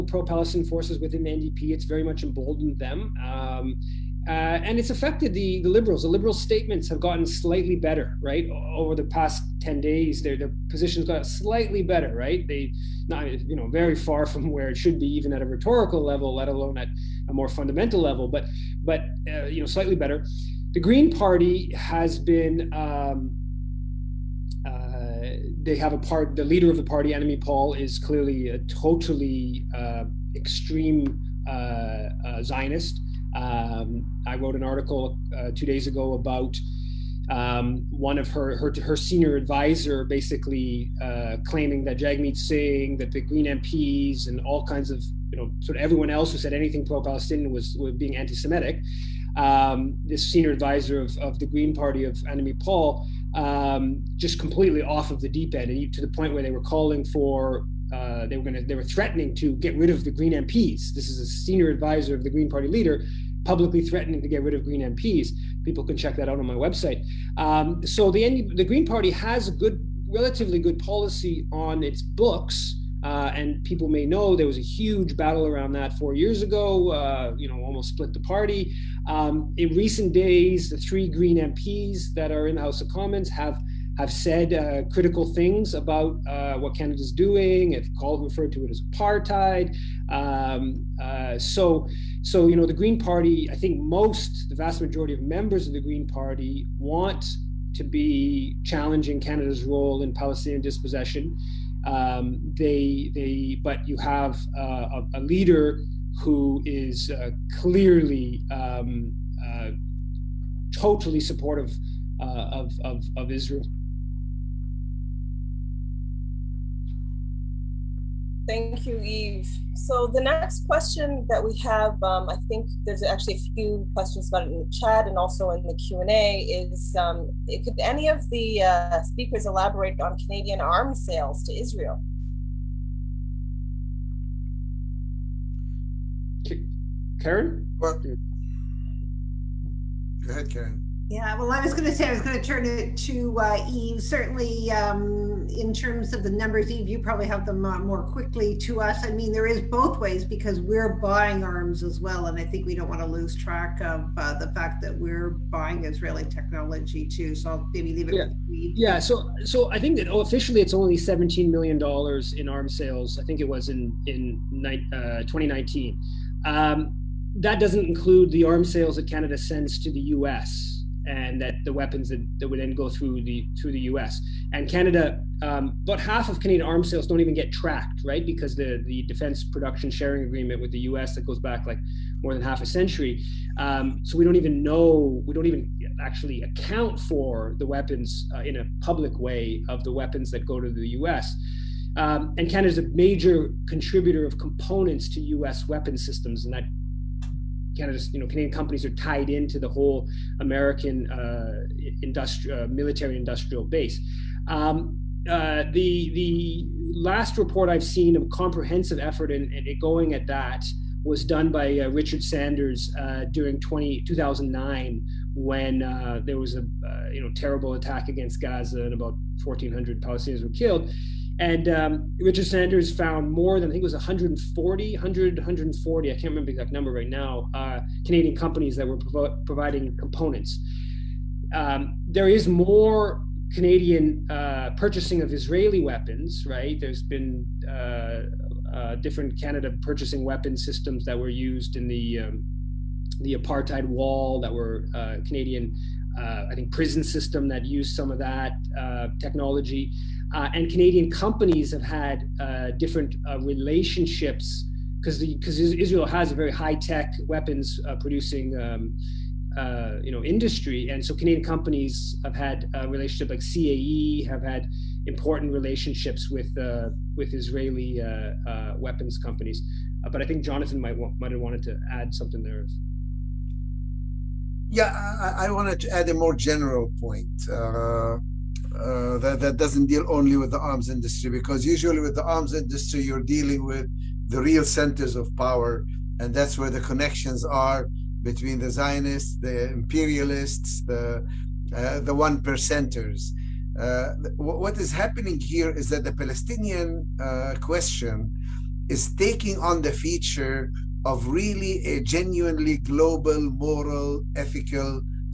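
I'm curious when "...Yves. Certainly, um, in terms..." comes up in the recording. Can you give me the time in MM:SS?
02:23.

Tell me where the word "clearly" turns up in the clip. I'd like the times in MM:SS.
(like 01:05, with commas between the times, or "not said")
00:27, 01:47.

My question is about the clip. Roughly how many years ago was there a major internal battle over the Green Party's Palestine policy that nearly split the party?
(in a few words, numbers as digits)
4 years.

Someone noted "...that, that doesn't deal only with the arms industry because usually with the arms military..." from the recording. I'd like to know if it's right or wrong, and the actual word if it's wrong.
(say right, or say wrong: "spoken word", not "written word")
wrong: "industry", not "military".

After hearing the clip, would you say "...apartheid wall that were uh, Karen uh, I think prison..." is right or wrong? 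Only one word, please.
wrong.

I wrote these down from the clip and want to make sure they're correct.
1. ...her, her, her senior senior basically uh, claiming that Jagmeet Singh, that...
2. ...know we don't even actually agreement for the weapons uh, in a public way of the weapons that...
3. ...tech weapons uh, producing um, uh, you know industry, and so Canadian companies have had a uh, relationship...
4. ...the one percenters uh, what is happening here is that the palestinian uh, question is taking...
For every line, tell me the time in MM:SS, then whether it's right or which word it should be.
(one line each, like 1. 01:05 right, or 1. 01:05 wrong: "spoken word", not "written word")
1. 00:38 wrong: "advisor", not "senior"
2. 03:04 wrong: "account", not "agreement"
3. 04:16 right
4. 04:51 right.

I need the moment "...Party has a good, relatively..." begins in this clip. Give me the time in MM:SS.
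01:08.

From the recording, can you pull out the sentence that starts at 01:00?
This is a senior advisor of the Green Party leader publicly threatening to get rid of Green MPs.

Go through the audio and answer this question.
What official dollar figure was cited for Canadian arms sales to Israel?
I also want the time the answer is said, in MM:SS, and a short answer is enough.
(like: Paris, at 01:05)
$17 million, at 02:40.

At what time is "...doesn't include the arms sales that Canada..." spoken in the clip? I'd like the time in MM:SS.
02:47.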